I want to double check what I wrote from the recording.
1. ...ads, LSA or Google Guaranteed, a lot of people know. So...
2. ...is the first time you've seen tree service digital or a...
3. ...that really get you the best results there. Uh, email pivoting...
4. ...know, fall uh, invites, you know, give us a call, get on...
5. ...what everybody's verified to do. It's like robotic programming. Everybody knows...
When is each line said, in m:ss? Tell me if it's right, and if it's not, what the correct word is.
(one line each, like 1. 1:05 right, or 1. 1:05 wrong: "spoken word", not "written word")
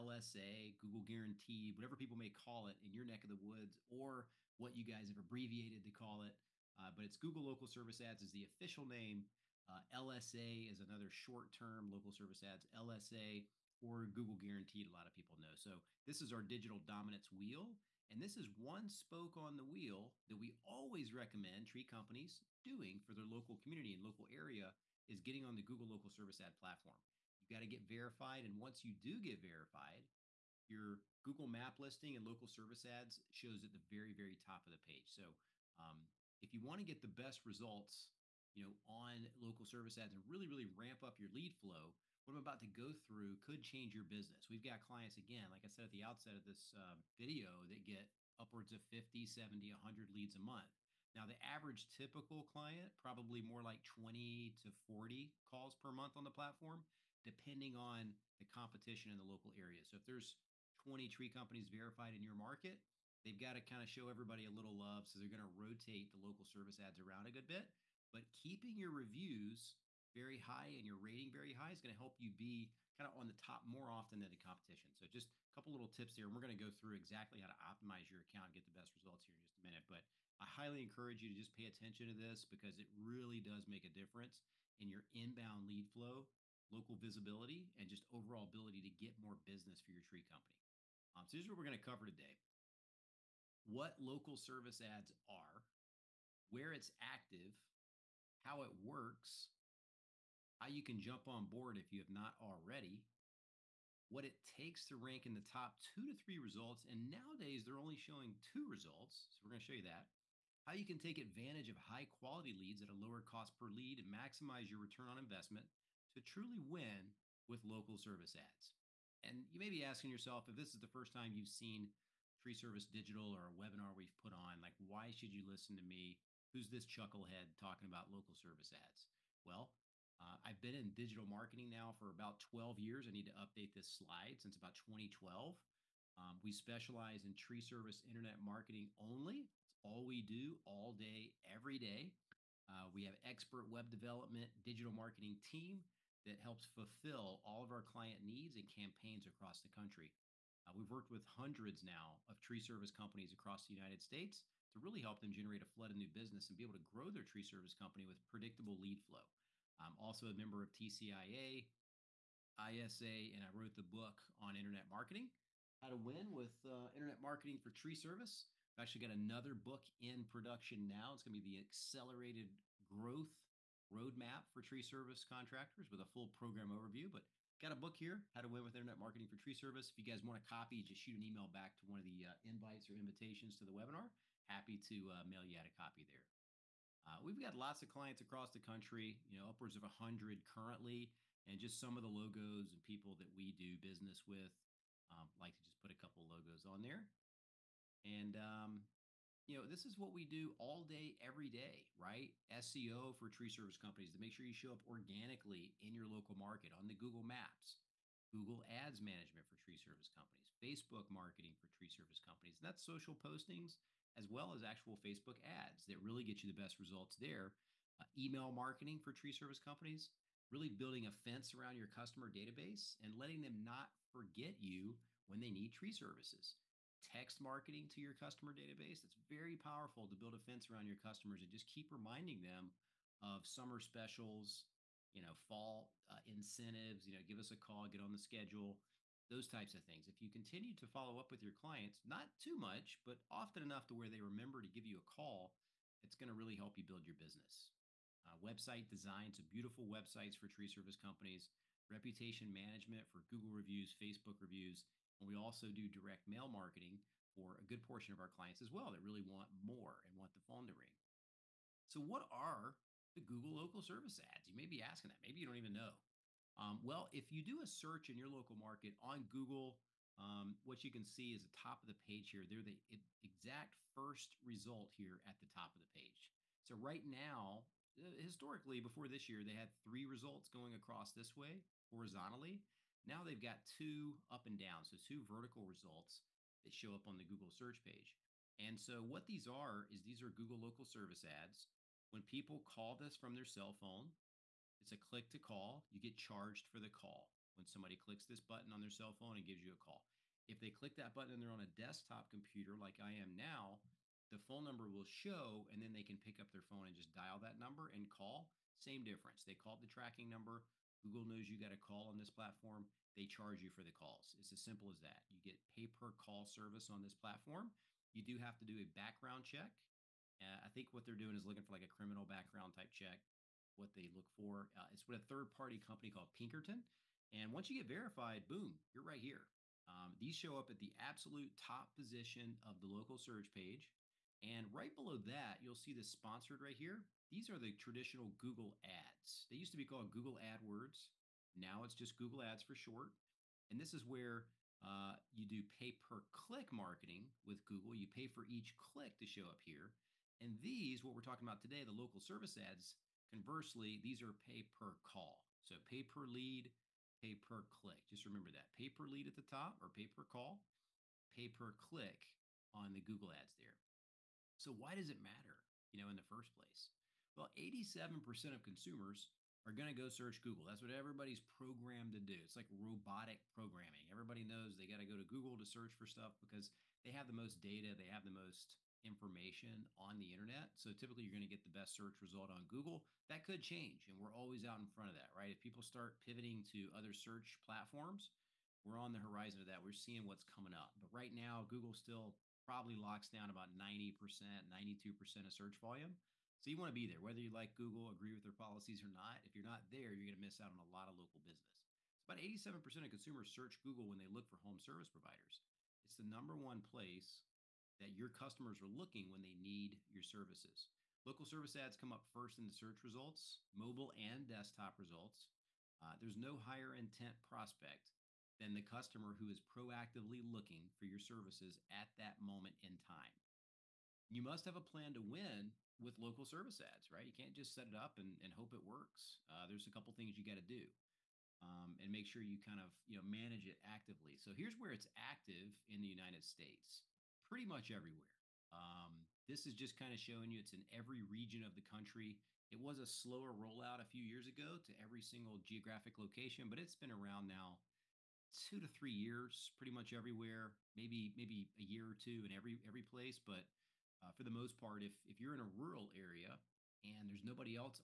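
1. 0:12 right
2. 2:00 right
3. 3:35 wrong: "marketing", not "pivoting"
4. 3:55 wrong: "incentives", not "invites"
5. 6:10 wrong: "programmed", not "verified".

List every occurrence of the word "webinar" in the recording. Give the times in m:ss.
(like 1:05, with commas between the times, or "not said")
2:03, 3:03.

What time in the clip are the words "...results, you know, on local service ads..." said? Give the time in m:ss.
0:37.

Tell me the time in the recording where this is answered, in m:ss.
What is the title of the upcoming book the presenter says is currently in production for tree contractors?
2:51.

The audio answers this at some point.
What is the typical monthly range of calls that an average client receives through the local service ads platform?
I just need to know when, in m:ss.
0:53.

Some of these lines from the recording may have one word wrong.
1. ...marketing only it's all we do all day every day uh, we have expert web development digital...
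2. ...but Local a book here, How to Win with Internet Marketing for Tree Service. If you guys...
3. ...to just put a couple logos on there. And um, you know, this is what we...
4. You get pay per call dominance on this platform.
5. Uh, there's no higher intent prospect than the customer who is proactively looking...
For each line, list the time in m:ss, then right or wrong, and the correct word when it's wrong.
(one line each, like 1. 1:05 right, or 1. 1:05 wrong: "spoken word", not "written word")
1. 2:18 right
2. 2:57 wrong: "Got", not "Local"
3. 3:15 right
4. 5:15 wrong: "service", not "dominance"
5. 6:55 right.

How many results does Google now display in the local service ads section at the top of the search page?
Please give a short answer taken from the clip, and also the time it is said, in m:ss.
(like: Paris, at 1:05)
2, at 1:47.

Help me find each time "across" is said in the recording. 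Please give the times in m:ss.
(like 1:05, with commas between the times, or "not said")
2:29, 2:33, 3:08, 4:40.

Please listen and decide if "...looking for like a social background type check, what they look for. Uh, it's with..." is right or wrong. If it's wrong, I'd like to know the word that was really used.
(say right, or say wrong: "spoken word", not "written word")
wrong: "criminal", not "social".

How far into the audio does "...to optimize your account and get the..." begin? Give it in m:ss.
1:17.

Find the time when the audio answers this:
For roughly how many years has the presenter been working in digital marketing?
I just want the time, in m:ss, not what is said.
2:12.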